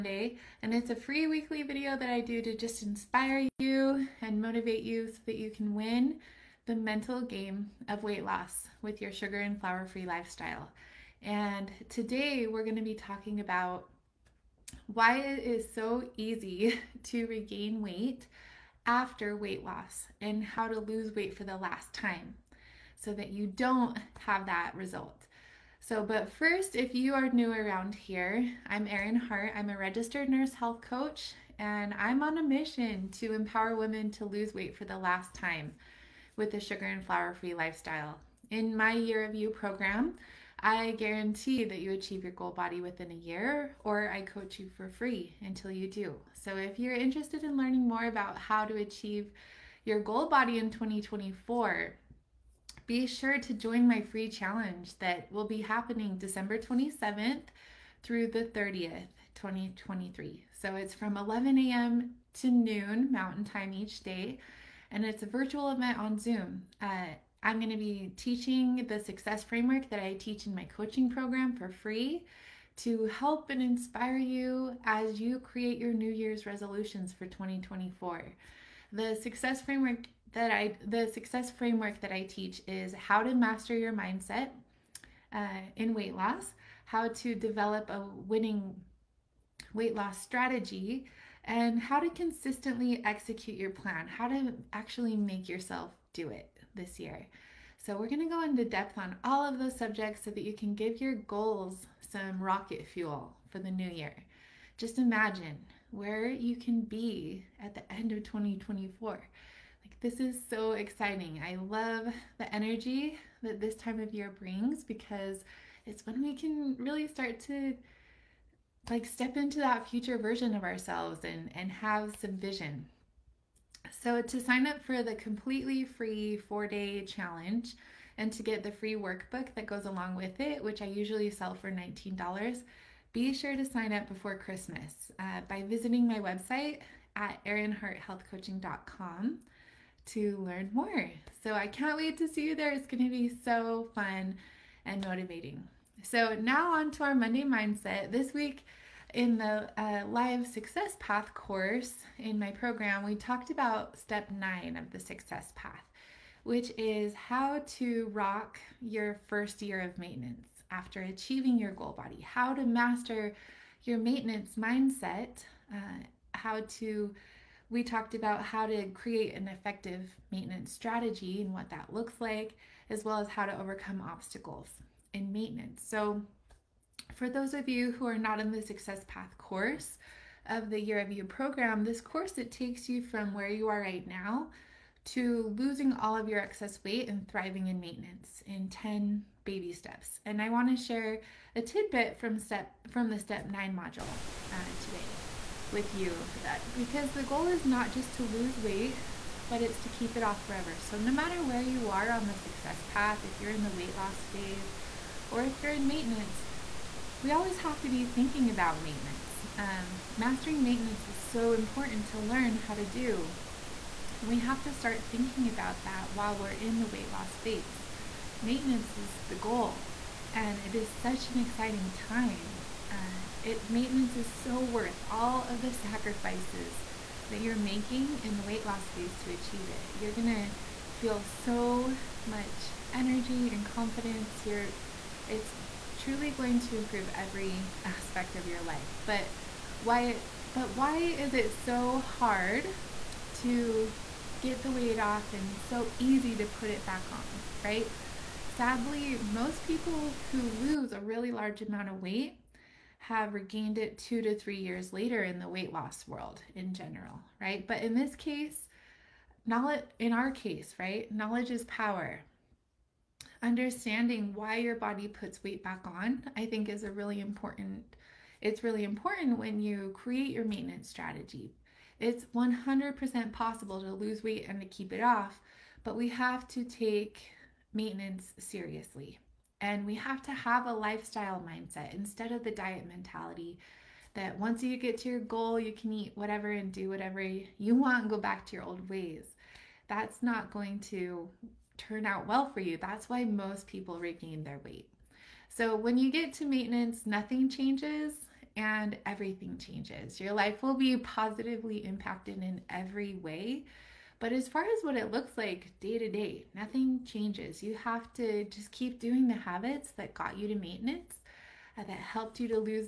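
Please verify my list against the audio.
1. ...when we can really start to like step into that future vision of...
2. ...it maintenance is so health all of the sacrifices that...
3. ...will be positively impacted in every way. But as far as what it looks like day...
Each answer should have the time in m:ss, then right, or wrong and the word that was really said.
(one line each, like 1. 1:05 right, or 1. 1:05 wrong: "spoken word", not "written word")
1. 1:56 wrong: "version", not "vision"
2. 3:43 wrong: "worth", not "health"
3. 5:00 right.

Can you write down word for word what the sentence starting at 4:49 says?
That's not going to turn out well for you.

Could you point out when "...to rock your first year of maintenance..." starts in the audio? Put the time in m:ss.
2:37.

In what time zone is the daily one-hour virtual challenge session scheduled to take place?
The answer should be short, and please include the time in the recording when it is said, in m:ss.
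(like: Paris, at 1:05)
Mountain Time, at 1:03.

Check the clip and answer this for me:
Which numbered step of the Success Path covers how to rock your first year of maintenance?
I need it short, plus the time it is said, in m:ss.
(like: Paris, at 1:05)
9, at 2:33.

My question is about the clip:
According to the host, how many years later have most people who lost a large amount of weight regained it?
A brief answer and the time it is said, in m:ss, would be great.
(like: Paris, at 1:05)
2 to 3, at 4:13.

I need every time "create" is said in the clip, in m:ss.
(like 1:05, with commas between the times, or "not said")
1:15, 2:48, 4:29.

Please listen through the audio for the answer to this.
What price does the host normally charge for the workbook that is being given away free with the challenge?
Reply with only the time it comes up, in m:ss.
2:11.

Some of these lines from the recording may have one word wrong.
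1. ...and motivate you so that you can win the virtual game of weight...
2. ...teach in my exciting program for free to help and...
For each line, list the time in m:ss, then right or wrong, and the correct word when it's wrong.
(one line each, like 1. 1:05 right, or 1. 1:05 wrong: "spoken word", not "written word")
1. 0:04 wrong: "mental", not "virtual"
2. 1:10 wrong: "coaching", not "exciting".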